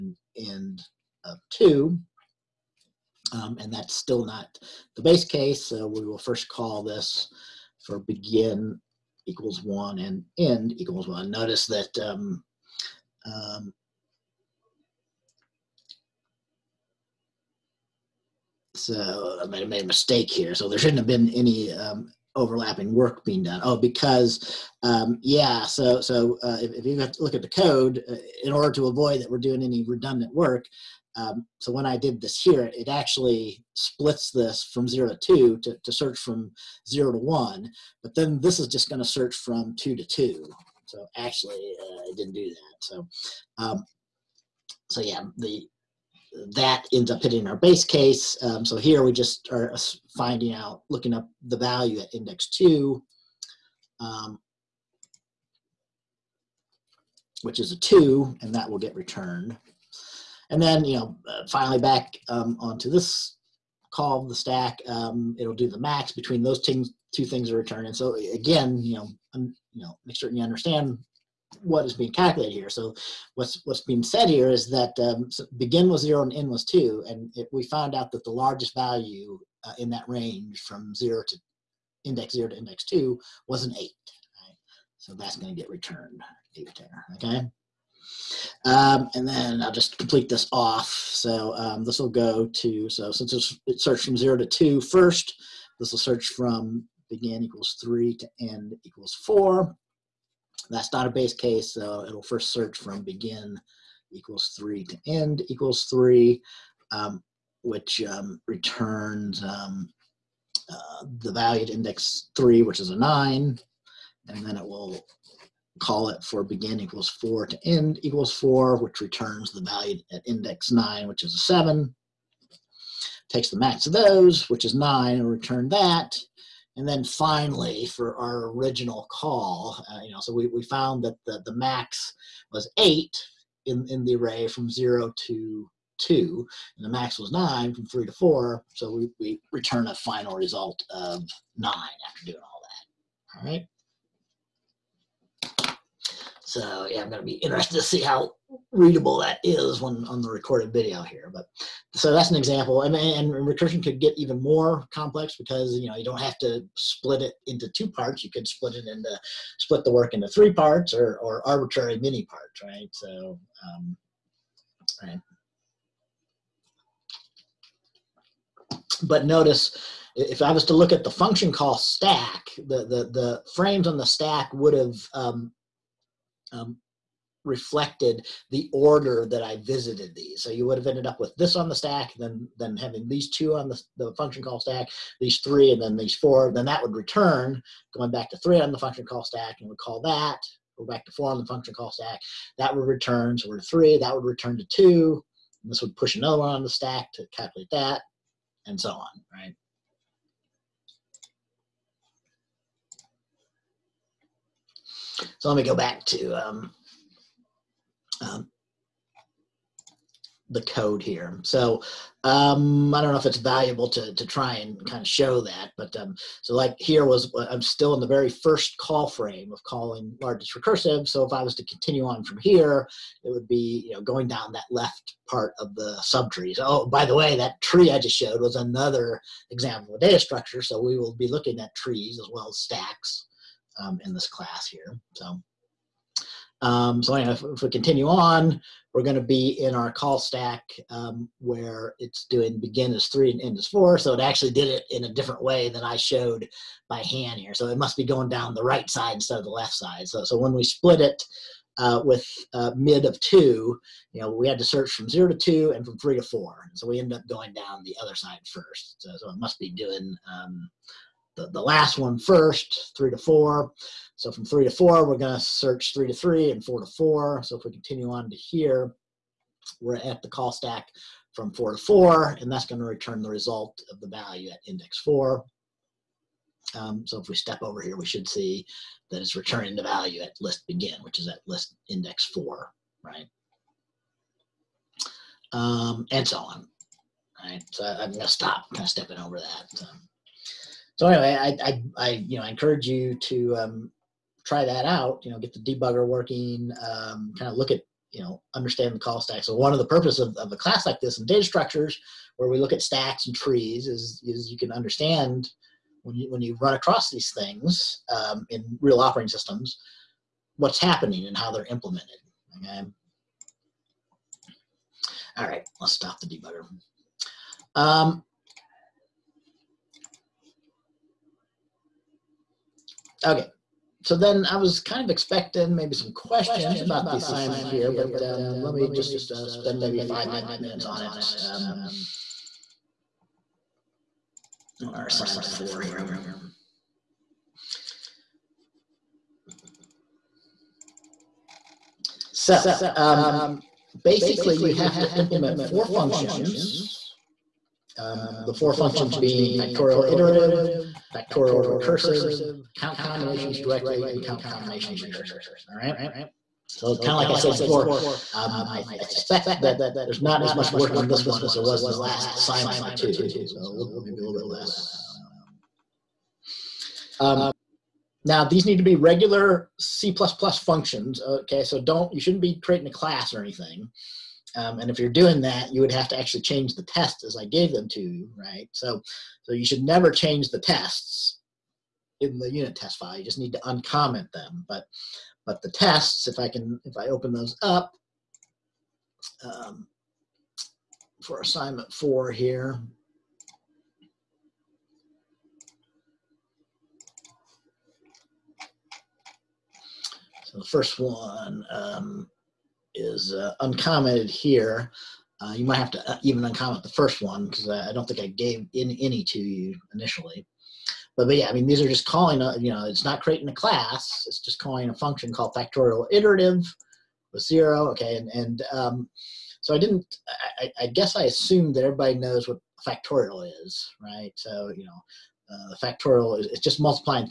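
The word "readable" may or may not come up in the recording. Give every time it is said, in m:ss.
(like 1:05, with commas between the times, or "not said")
2:28.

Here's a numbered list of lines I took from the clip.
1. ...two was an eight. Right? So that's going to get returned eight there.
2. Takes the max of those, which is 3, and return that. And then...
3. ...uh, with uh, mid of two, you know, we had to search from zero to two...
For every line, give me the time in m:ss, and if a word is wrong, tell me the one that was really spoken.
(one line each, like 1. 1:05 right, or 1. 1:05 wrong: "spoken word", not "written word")
1. 1:22 right
2. 2:03 wrong: "9", not "3"
3. 4:11 right.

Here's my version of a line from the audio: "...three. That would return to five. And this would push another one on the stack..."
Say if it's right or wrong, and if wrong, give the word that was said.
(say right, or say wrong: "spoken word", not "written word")
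wrong: "two", not "five".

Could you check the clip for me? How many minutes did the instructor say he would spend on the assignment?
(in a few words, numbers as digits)
5.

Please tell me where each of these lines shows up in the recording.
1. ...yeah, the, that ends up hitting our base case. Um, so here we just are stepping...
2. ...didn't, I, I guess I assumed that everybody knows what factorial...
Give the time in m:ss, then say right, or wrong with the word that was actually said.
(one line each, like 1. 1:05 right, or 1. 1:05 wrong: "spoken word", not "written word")
1. 0:45 wrong: "finding", not "stepping"
2. 6:59 right.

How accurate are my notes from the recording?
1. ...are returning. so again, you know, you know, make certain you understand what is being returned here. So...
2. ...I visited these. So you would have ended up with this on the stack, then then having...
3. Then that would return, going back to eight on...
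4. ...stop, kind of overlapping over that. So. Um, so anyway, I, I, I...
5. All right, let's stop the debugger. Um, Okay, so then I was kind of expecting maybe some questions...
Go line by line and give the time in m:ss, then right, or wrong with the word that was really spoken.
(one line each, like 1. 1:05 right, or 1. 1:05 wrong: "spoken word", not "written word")
1. 1:07 wrong: "calculated", not "returned"
2. 2:59 right
3. 3:06 wrong: "three", not "eight"
4. 4:48 wrong: "stepping", not "overlapping"
5. 5:15 right.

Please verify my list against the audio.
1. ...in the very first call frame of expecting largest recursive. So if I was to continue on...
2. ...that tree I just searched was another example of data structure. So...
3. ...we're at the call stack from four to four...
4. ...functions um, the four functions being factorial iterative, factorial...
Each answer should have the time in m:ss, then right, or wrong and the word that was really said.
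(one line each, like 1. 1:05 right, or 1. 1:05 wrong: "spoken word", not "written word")
1. 3:37 wrong: "calling", not "expecting"
2. 3:47 wrong: "showed", not "searched"
3. 4:29 right
4. 5:45 right.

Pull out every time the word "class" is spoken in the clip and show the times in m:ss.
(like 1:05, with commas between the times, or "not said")
3:54, 5:00, 6:12, 6:53.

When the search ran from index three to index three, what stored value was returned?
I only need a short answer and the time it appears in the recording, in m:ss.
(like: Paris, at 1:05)
9, at 1:52.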